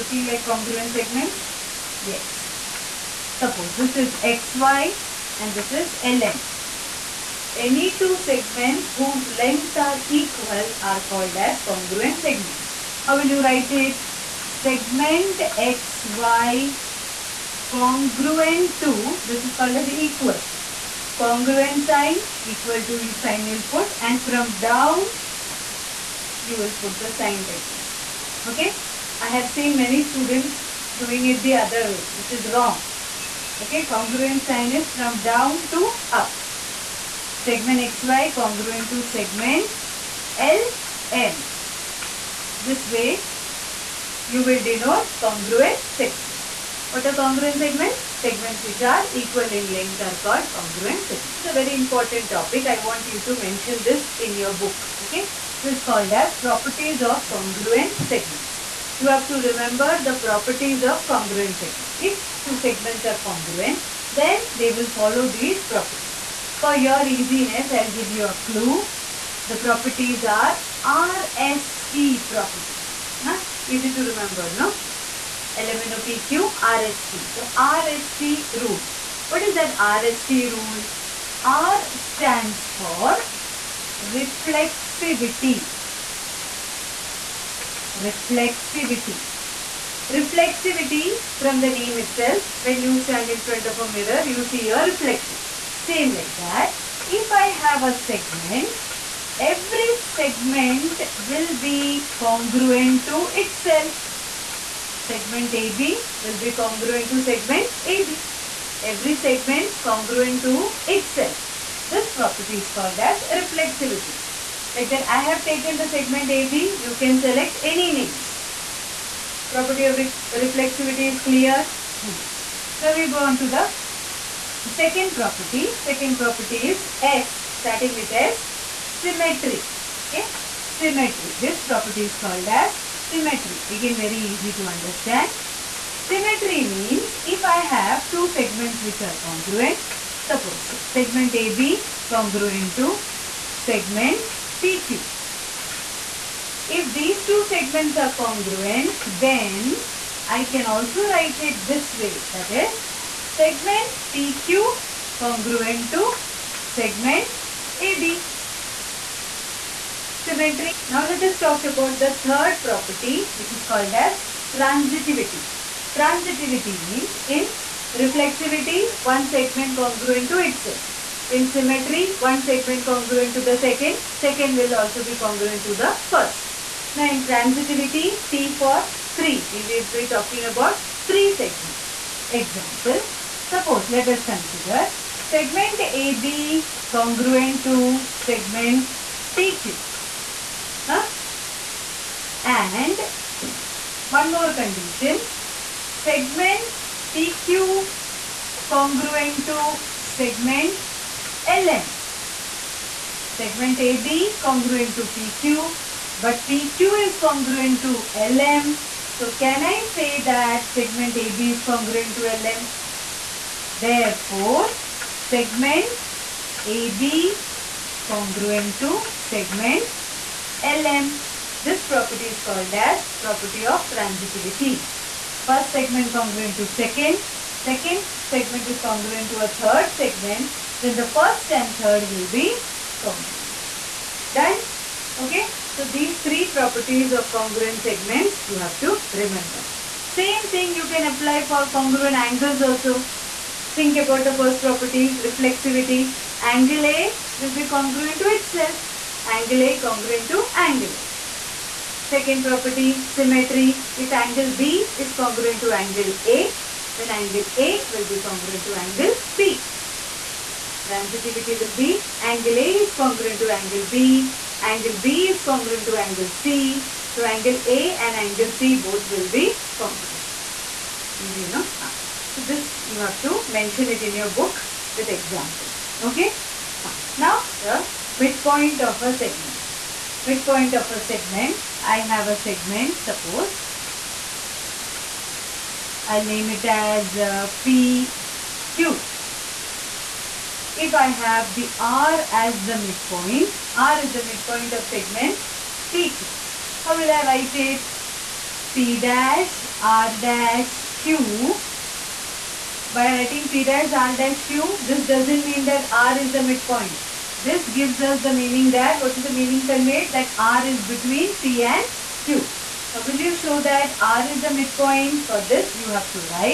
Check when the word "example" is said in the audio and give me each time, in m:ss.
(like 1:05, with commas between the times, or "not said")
3:02, 4:35.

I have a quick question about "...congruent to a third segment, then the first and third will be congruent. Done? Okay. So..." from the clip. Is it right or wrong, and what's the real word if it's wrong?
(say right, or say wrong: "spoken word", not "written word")
right.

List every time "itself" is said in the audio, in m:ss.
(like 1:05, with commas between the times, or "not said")
1:31, 1:43, 1:50, 2:50, 4:08.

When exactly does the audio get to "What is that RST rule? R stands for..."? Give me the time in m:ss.
1:19.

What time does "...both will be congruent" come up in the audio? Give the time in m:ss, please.
4:28.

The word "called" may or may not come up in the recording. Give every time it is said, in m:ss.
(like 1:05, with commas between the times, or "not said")
0:11, 0:19, 0:50, 0:55, 1:52, 2:12, 2:43, 3:42.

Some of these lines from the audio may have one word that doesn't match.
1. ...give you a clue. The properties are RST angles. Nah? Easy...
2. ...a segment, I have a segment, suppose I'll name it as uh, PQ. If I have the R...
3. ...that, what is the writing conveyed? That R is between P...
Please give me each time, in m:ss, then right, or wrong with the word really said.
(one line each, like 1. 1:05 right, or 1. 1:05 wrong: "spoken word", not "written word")
1. 1:07 wrong: "properties", not "angles"
2. 4:40 right
3. 5:08 wrong: "meaning", not "writing".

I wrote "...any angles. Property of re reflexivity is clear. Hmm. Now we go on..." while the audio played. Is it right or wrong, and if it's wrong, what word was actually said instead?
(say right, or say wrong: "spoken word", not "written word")
wrong: "names", not "angles".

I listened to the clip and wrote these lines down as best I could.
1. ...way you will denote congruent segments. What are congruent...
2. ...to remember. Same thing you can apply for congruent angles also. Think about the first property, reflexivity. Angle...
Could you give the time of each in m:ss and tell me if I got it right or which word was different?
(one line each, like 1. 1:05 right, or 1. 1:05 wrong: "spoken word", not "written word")
1. 0:42 right
2. 3:58 right.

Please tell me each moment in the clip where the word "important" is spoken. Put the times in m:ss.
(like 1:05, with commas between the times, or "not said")
0:51.